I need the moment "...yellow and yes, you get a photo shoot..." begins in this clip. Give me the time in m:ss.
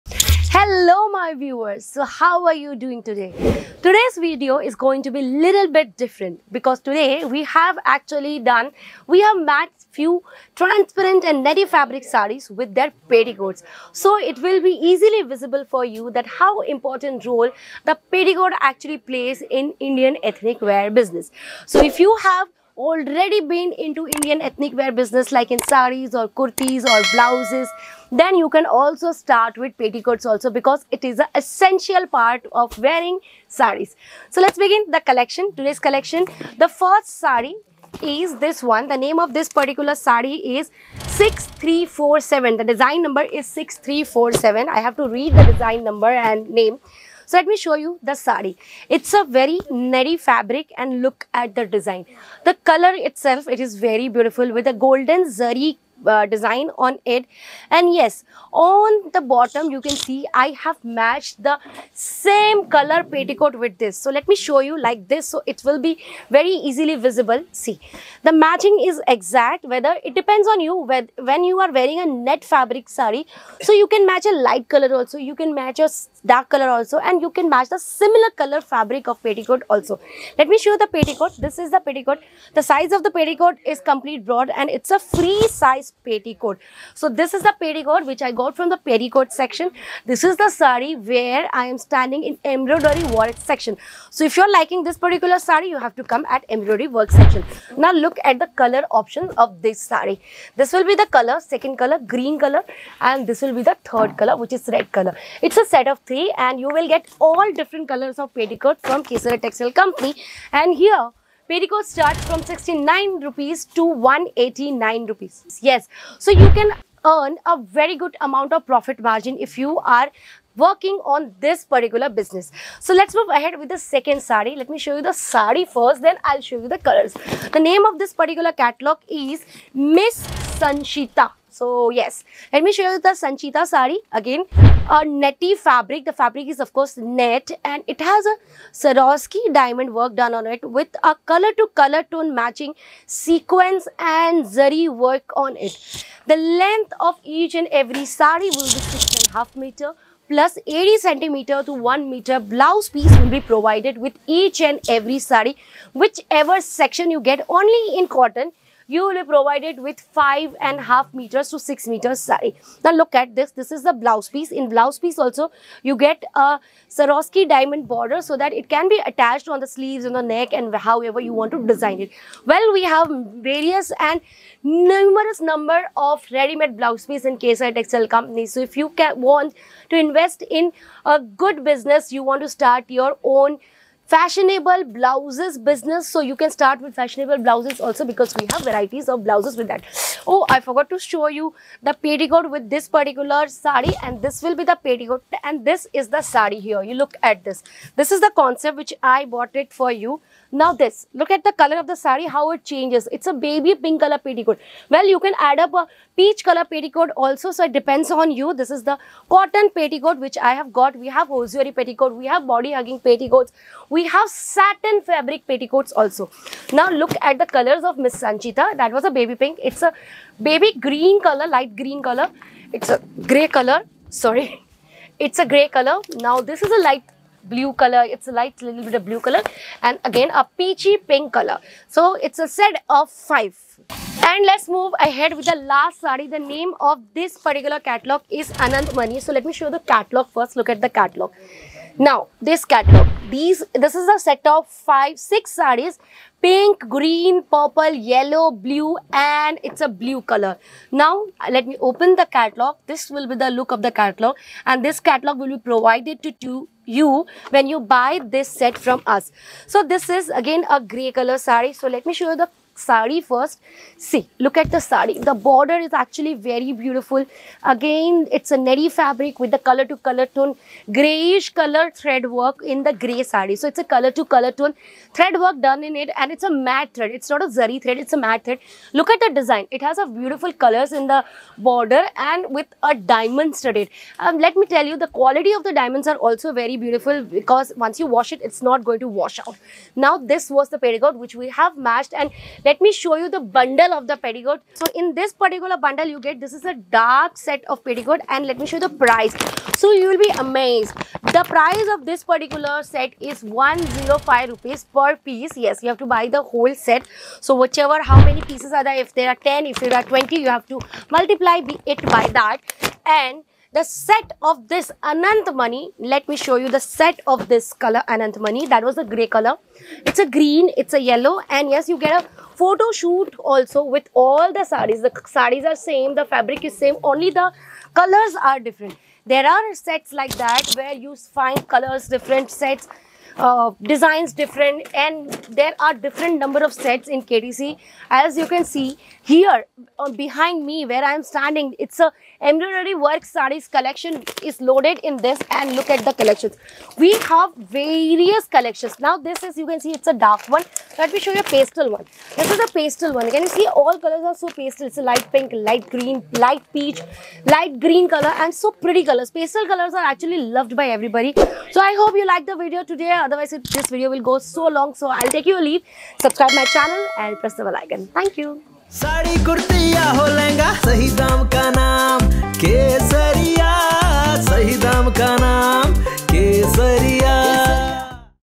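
5:21.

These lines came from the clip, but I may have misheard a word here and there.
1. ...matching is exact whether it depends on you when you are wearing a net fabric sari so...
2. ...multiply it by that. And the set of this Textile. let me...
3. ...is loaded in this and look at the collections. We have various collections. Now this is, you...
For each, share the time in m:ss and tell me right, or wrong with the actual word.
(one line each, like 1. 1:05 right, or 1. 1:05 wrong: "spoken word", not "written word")
1. 1:08 right
2. 5:11 wrong: "Mani", not "Textile"
3. 5:44 right.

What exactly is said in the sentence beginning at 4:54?
So in this particular bundle you get, this is a dark set of petticoat and let me show you the price.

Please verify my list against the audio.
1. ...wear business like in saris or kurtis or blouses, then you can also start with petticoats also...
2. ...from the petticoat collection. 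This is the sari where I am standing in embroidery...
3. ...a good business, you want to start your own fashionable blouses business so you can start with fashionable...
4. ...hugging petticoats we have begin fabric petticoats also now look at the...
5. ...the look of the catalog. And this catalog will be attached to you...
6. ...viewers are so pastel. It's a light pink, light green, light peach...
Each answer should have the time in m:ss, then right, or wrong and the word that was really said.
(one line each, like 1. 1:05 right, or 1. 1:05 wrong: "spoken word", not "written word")
1. 0:24 right
2. 1:28 wrong: "section", not "collection"
3. 3:01 right
4. 3:32 wrong: "satin", not "begin"
5. 4:13 wrong: "provided", not "attached"
6. 5:53 wrong: "colors", not "viewers".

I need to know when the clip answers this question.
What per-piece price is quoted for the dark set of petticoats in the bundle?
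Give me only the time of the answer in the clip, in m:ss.
5:03.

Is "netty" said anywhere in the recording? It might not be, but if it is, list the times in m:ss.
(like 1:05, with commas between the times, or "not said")
0:11, 0:49, 2:15, 4:28.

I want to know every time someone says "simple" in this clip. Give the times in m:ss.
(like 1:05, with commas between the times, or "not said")
not said.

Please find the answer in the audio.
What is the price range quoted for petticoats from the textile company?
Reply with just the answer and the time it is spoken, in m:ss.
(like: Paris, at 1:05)
69 to 189 rupees, at 1:52.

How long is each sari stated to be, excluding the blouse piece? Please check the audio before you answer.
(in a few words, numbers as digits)
6.5 meters.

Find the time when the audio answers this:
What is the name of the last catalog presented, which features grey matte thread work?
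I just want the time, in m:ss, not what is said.
3:58.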